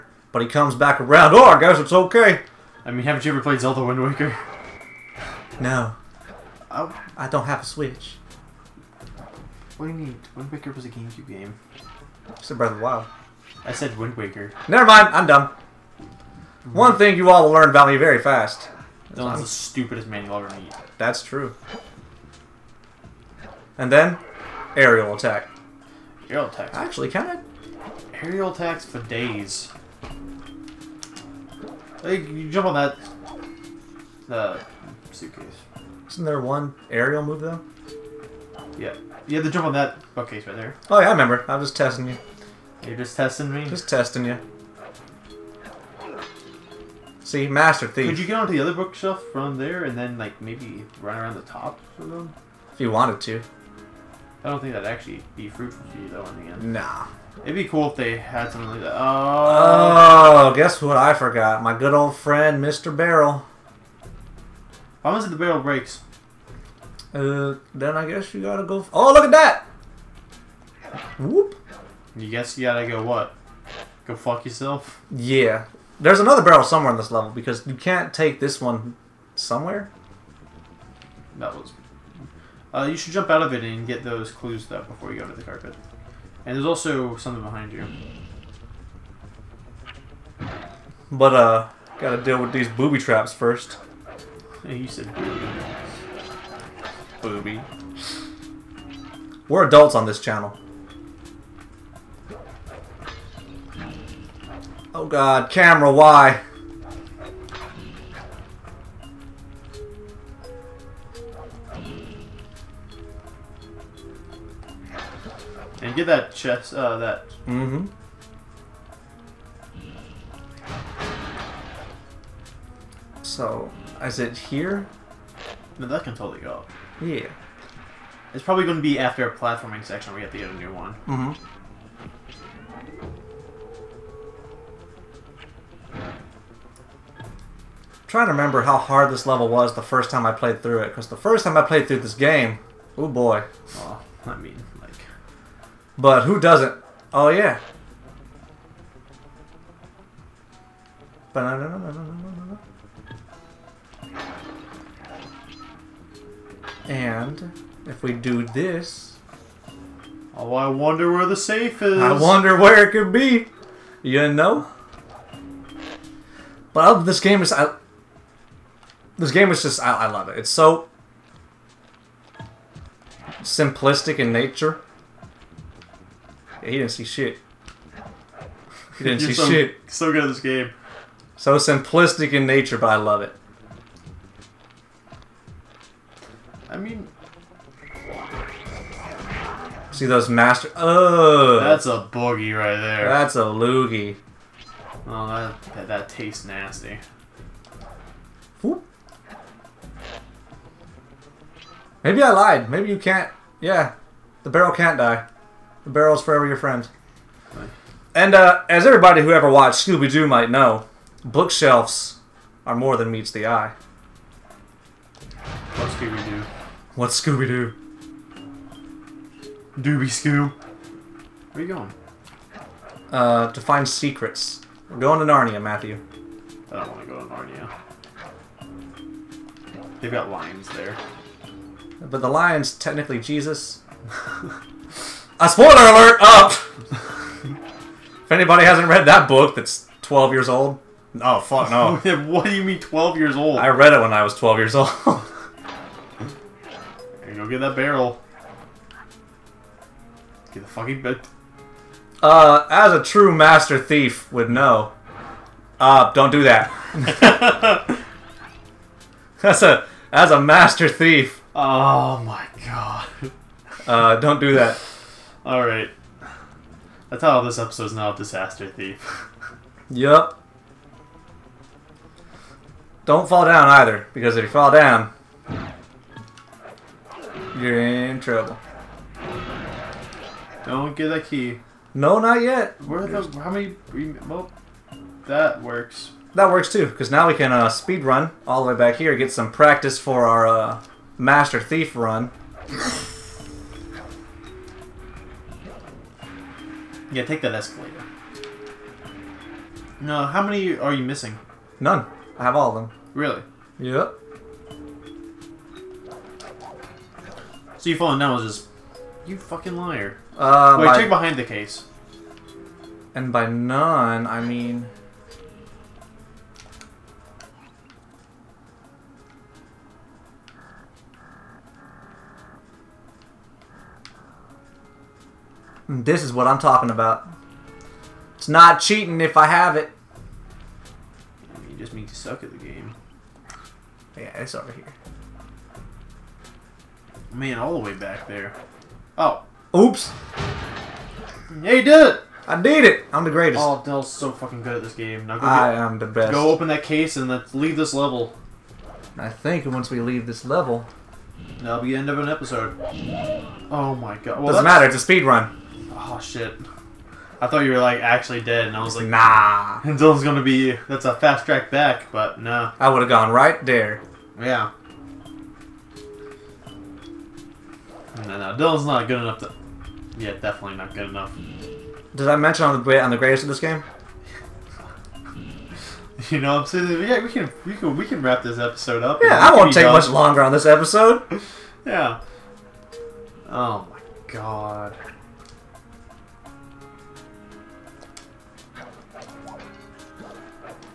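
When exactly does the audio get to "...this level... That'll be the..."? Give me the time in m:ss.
5:50.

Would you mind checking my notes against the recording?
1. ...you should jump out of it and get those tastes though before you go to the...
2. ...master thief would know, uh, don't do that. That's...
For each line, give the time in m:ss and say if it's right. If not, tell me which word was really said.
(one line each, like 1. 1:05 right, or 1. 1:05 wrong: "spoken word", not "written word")
1. 1:22 wrong: "clues", not "tastes"
2. 4:13 right.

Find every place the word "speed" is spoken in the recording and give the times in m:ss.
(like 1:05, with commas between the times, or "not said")
4:47, 5:54.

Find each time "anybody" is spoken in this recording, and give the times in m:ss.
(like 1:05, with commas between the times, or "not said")
3:58.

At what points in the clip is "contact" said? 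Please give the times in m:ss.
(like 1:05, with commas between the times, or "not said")
not said.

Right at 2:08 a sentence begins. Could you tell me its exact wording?
It's probably going to be after a platforming section We have to get a new one.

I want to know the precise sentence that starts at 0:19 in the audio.
Dylan's the stupidest man you'll ever meet.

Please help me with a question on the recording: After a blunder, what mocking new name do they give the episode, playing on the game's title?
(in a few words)
Disaster Thief.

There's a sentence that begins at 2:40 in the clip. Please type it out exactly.
Oh, I wonder where the safe is.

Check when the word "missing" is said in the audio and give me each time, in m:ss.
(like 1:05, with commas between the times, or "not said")
5:01.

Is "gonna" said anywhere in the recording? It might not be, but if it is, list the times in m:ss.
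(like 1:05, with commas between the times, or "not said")
6:00.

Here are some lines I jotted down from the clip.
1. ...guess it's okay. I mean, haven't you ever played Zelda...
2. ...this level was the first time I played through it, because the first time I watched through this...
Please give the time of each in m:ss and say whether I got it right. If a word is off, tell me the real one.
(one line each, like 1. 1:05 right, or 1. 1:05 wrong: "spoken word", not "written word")
1. 0:01 right
2. 2:19 wrong: "played", not "watched".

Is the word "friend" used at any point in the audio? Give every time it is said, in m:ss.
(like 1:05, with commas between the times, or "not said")
1:02, 3:26.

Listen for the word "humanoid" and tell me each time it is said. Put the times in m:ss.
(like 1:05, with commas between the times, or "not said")
not said.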